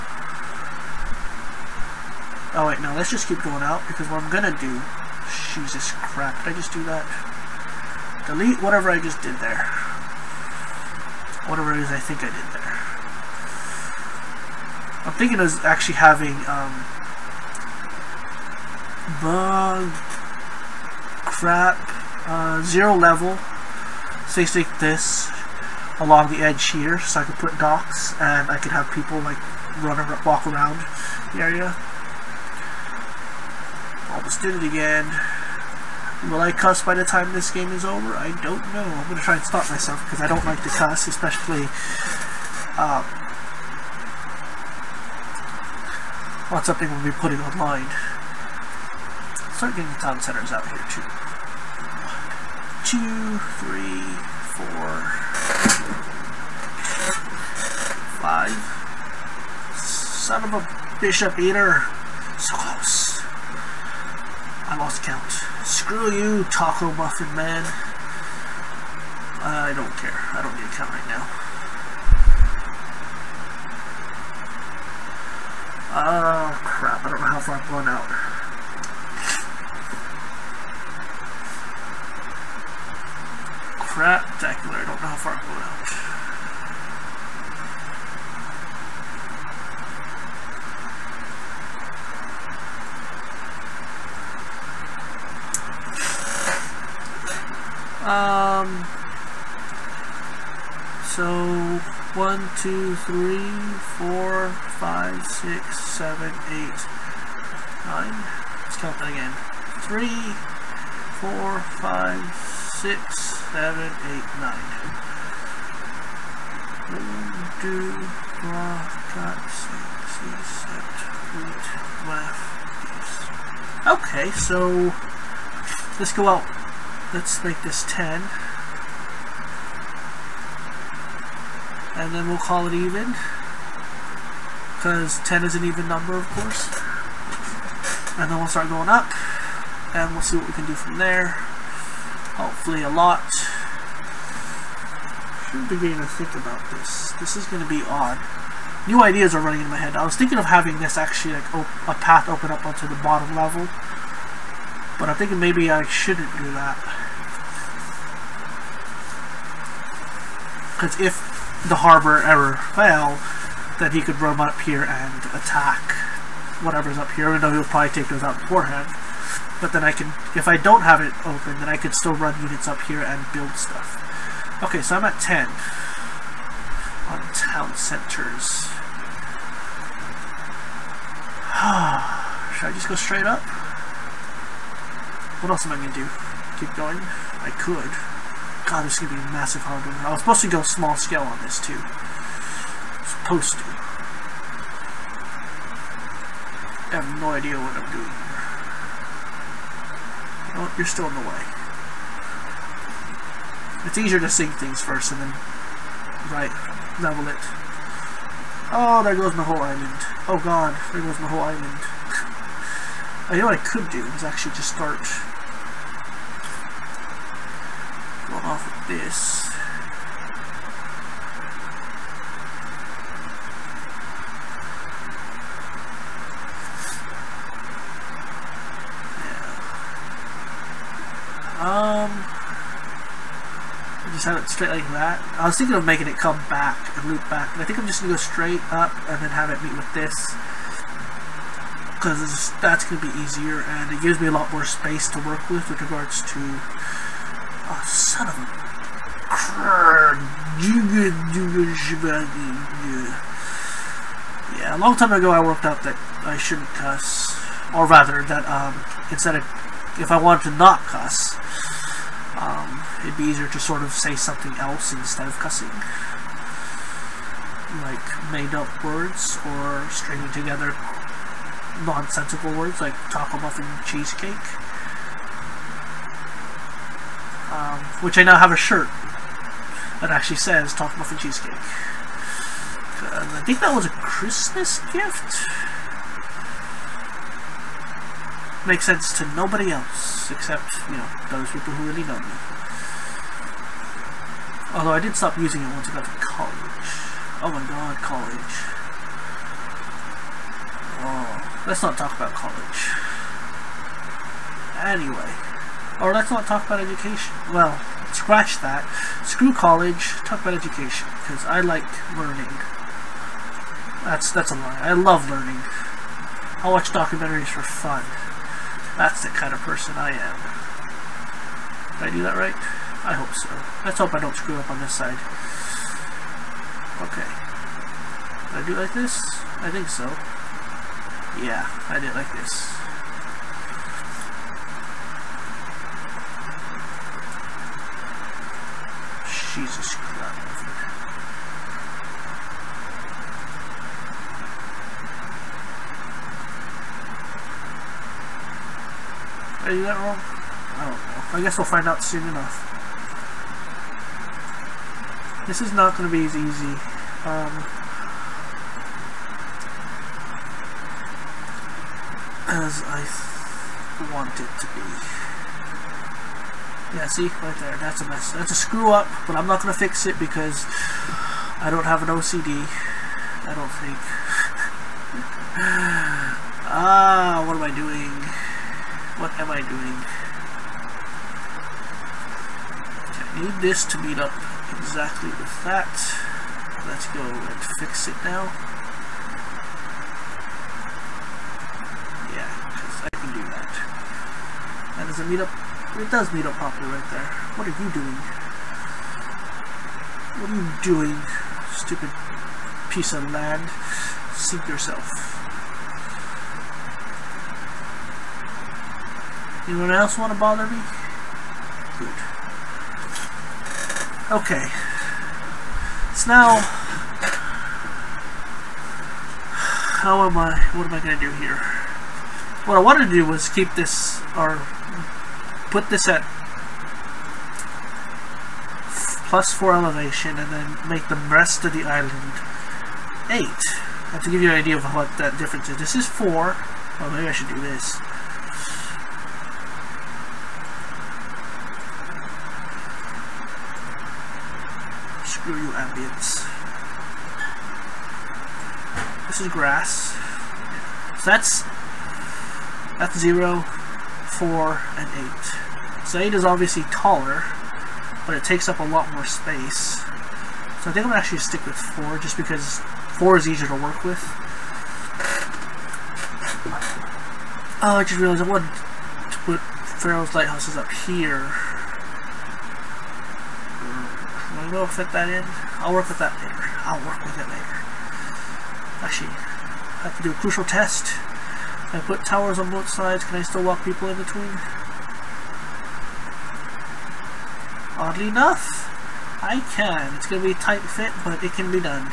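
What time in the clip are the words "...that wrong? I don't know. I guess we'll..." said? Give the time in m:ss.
5:49.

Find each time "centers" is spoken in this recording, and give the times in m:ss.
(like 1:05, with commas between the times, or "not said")
0:50, 2:57.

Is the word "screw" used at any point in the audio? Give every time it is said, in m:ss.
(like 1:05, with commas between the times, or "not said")
1:05, 5:09, 5:24, 6:08, 7:25.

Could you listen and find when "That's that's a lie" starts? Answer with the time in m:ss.
5:14.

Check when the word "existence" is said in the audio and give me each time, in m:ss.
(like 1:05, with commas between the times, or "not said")
not said.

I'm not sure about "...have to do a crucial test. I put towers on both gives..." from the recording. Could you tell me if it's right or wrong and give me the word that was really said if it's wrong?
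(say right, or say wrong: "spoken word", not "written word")
wrong: "sides", not "gives".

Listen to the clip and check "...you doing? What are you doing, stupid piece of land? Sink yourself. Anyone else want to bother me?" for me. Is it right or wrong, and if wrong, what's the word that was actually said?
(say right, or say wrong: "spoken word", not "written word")
right.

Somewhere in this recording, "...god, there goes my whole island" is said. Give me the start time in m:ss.
3:30.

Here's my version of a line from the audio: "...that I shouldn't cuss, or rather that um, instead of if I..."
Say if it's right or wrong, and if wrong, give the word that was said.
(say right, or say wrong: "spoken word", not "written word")
right.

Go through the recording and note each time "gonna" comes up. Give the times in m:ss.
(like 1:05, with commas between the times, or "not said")
0:04, 3:58, 4:02.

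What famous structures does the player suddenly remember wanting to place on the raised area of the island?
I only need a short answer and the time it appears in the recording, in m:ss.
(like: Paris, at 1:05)
Pharaoh's Lighthouses, at 7:50.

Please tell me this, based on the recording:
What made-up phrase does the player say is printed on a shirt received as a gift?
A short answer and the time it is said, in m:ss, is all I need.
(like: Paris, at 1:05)
top Muffin Cheesecake, at 4:40.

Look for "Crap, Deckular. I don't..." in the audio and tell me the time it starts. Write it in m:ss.
1:23.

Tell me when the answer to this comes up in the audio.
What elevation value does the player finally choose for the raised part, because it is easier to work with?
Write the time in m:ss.
7:41.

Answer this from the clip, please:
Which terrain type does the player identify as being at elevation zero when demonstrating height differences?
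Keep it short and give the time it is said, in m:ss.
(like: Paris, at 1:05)
grass, at 7:29.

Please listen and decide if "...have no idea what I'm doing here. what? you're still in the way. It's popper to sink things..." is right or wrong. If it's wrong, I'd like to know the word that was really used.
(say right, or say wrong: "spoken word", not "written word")
wrong: "easier", not "popper".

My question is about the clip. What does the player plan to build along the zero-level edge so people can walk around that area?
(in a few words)
docks.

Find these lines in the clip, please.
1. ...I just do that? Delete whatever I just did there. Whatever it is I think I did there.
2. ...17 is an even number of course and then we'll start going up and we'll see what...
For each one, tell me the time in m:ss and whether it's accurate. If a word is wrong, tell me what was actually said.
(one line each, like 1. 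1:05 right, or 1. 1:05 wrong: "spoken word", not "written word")
1. 0:06 right
2. 2:15 wrong: "10", not "17".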